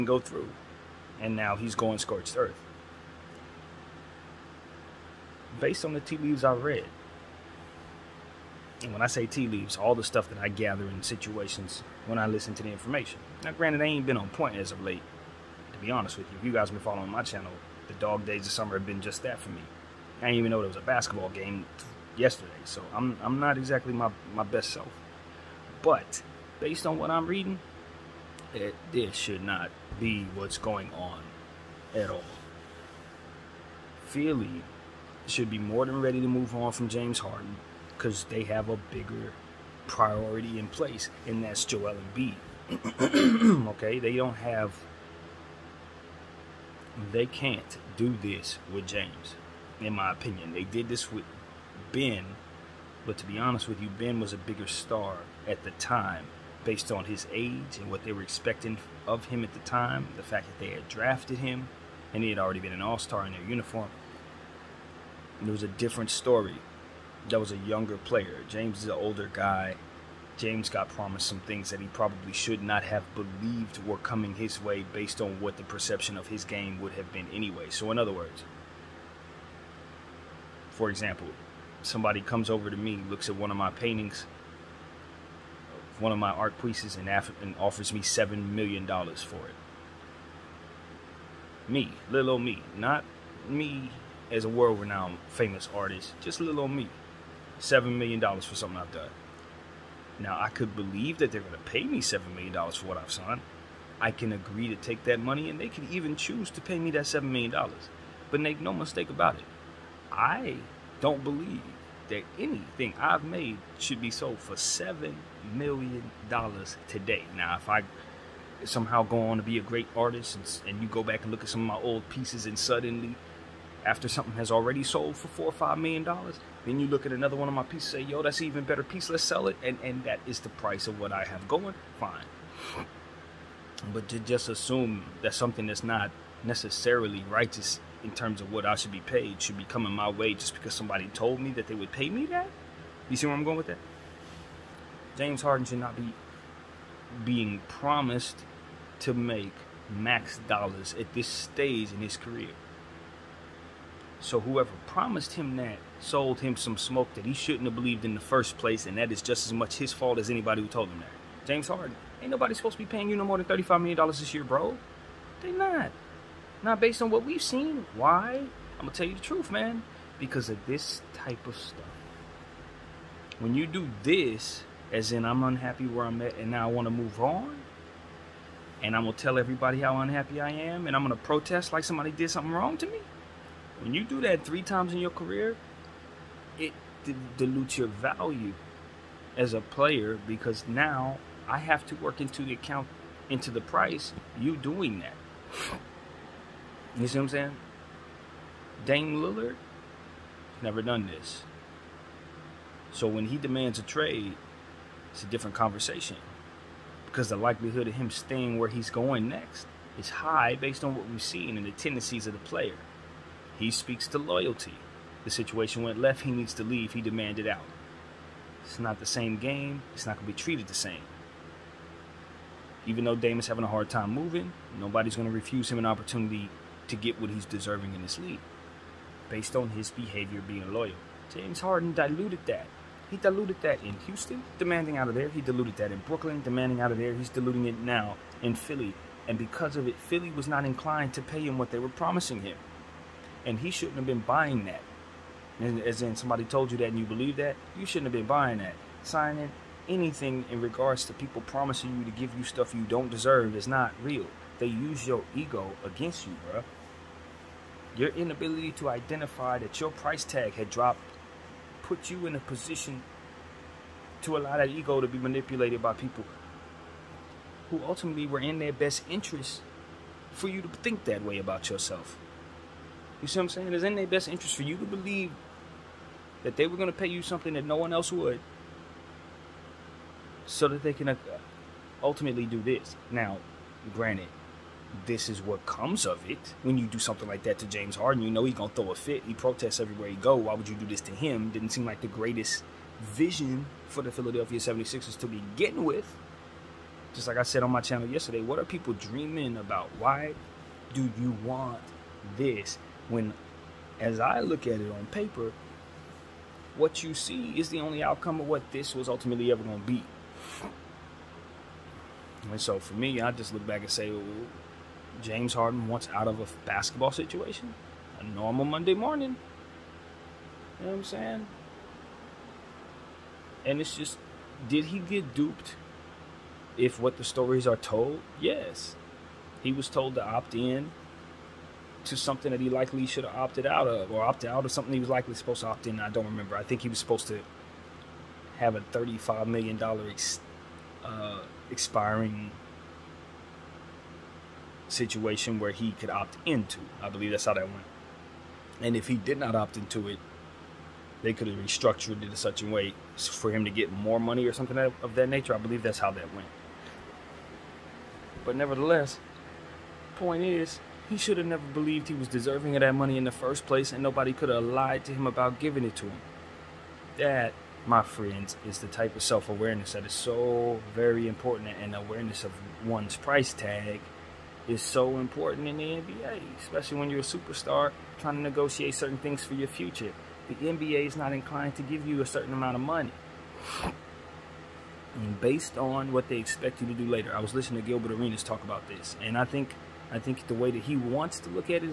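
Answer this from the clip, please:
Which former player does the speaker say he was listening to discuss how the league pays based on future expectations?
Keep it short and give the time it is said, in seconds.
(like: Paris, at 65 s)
Gilbert Arenas, at 387 s.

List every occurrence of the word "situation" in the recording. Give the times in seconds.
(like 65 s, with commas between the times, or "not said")
11 s, 215 s, 317 s, 344 s.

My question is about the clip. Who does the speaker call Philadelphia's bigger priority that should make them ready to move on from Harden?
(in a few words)
Joel Embiid.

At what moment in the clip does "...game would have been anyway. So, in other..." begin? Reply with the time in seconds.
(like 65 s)
76 s.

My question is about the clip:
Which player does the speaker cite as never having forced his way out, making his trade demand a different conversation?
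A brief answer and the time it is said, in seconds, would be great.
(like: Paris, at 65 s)
Dame Lillard, at 198 s.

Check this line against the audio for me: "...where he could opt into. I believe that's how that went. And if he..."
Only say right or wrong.
right.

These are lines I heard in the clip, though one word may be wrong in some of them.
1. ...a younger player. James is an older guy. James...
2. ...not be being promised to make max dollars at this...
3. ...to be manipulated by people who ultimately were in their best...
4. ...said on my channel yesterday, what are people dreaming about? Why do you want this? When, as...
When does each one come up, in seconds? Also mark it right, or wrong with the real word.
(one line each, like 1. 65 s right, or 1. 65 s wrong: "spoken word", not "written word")
1. 67 s right
2. 145 s right
3. 265 s right
4. 297 s right.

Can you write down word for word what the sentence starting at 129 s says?
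And and that is the price of what I have going, fine.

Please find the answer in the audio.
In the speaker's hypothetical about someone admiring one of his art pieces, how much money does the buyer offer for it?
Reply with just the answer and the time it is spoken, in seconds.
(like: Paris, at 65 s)
$7 million, at 88 s.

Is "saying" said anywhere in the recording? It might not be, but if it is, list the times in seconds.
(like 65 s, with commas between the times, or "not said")
197 s, 273 s, 321 s.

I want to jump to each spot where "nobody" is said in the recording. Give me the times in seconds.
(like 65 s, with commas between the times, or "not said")
162 s, 224 s, 364 s.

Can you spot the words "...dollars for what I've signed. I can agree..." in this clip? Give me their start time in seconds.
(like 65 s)
102 s.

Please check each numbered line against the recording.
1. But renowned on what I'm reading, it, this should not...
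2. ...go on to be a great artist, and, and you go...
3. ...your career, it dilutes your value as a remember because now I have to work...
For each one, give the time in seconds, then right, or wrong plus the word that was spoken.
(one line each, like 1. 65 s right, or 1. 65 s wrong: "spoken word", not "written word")
1. 25 s wrong: "based", not "renowned"
2. 119 s right
3. 185 s wrong: "player", not "remember".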